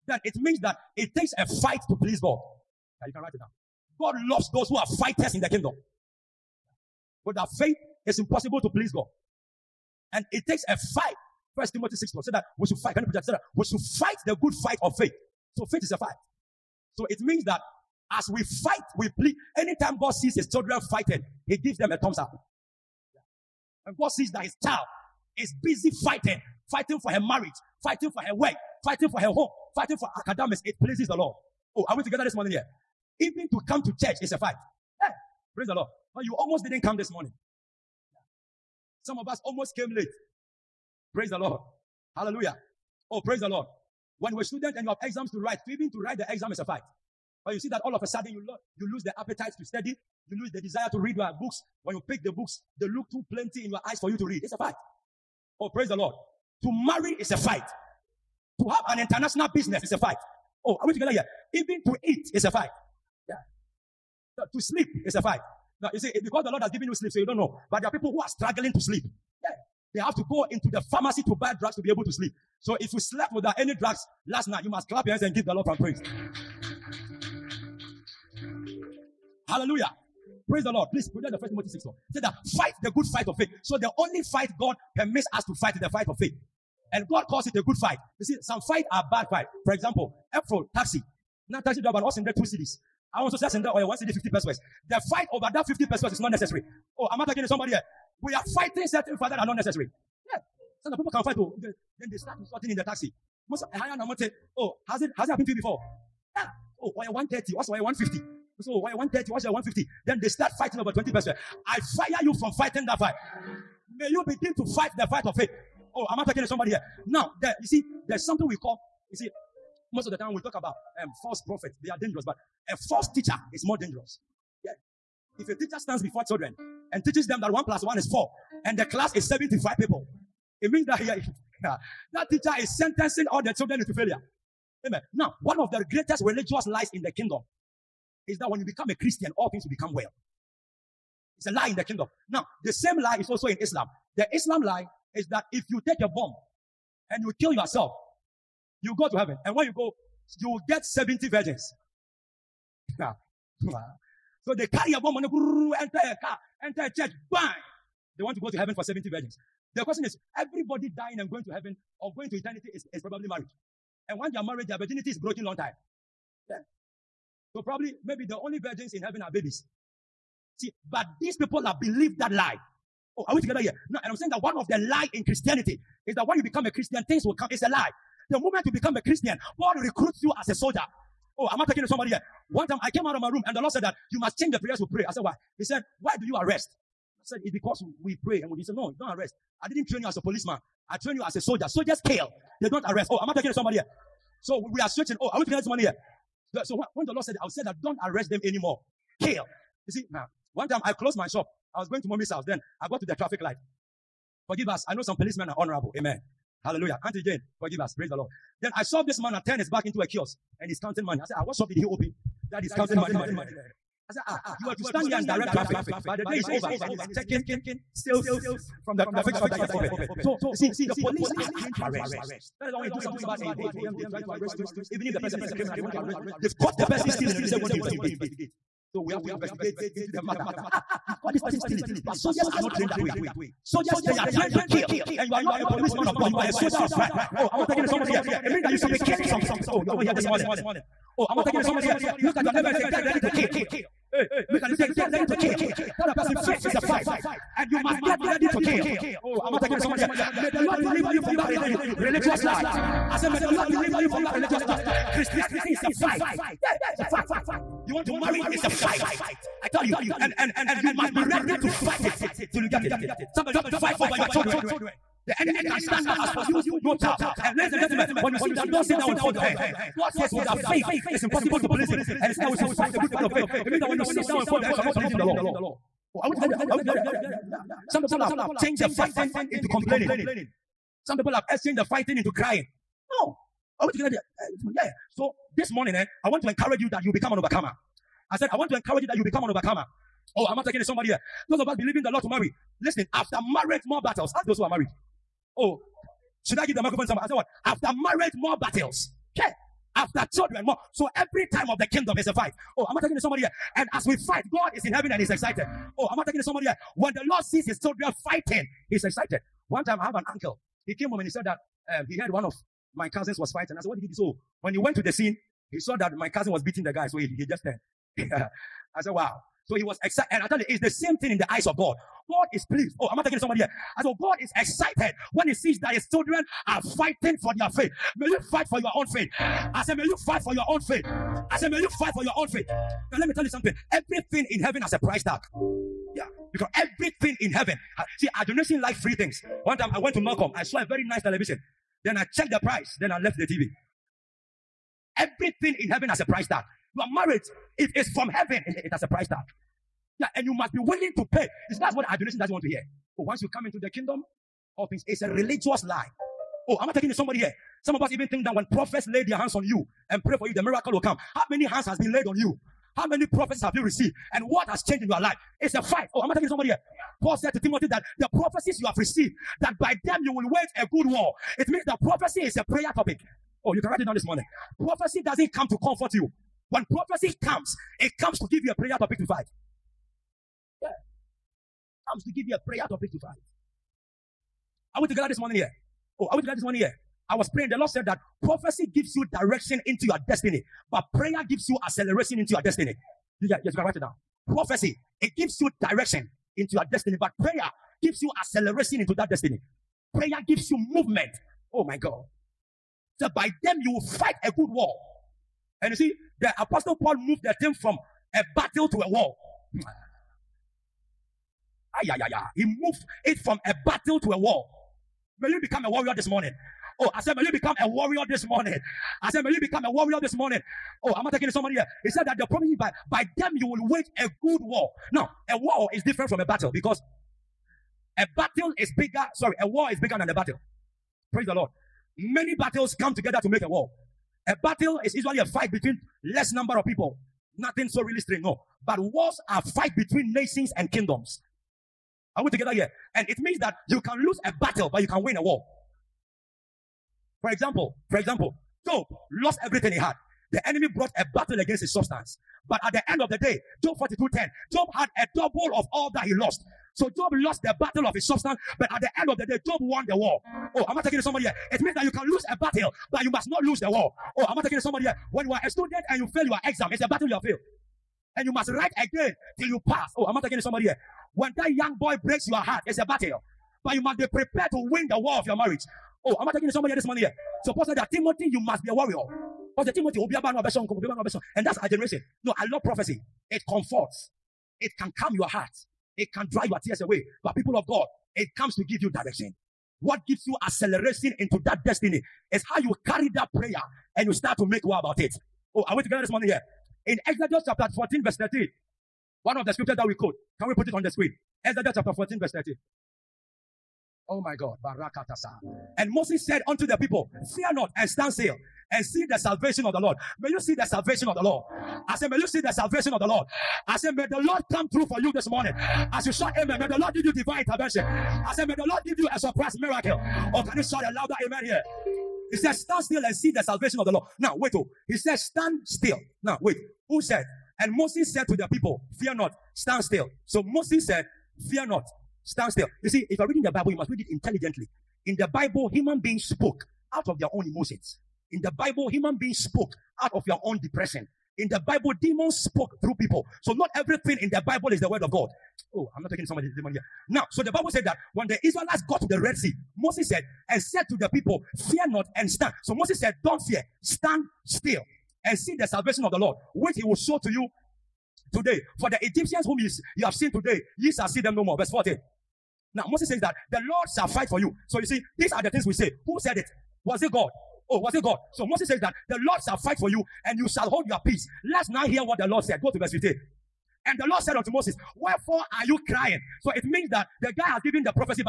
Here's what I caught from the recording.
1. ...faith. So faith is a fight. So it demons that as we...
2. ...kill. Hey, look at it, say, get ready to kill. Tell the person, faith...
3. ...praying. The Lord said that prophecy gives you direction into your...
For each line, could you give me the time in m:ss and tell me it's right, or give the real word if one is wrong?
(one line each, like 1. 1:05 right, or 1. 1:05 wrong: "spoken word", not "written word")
1. 0:14 wrong: "means", not "demons"
2. 4:03 right
3. 6:27 right.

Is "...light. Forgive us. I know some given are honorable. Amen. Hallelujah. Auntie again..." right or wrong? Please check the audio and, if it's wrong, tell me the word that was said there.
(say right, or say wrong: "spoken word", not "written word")
wrong: "policemen", not "given".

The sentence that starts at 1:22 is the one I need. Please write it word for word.
Say that fight the good fight of faith.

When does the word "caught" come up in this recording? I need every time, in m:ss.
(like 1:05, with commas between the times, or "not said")
3:46, 3:51.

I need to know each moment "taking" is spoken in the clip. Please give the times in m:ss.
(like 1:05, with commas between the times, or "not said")
4:50, 9:06.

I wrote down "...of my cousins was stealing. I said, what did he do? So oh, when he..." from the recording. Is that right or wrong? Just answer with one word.
wrong.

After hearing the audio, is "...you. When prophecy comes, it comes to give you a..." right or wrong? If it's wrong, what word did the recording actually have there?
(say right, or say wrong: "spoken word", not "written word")
right.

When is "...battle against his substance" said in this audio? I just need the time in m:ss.
7:31.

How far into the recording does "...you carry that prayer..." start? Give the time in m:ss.
8:12.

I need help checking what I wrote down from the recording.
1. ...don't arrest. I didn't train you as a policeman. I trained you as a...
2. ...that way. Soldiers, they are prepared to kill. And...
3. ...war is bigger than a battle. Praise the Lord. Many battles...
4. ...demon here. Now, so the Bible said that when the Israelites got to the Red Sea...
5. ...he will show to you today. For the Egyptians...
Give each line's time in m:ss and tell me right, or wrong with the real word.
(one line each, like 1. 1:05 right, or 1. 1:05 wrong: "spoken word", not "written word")
1. 3:08 right
2. 3:52 wrong: "trained", not "prepared"
3. 7:09 right
4. 9:06 right
5. 9:16 right.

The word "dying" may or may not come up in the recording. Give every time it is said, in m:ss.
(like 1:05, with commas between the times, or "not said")
2:40.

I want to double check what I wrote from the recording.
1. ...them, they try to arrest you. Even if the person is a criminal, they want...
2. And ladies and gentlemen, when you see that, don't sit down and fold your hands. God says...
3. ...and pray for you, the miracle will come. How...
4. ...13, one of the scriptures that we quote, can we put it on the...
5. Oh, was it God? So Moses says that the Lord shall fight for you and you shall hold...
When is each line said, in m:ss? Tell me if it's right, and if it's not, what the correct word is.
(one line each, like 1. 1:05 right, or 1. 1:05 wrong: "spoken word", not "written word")
1. 3:43 right
2. 4:27 right
3. 6:00 right
4. 8:18 right
5. 9:27 right.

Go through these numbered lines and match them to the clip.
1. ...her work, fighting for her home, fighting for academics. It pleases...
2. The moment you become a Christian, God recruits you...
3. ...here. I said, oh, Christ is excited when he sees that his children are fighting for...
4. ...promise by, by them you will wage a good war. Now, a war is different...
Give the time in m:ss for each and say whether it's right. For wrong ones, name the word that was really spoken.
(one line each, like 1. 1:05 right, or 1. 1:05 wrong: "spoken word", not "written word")
1. 0:28 right
2. 2:58 right
3. 5:23 wrong: "God", not "Christ"
4. 7:02 right.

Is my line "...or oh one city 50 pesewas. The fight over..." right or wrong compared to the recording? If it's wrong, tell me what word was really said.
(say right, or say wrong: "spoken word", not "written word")
right.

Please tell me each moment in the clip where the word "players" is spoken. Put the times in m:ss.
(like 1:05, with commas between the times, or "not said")
not said.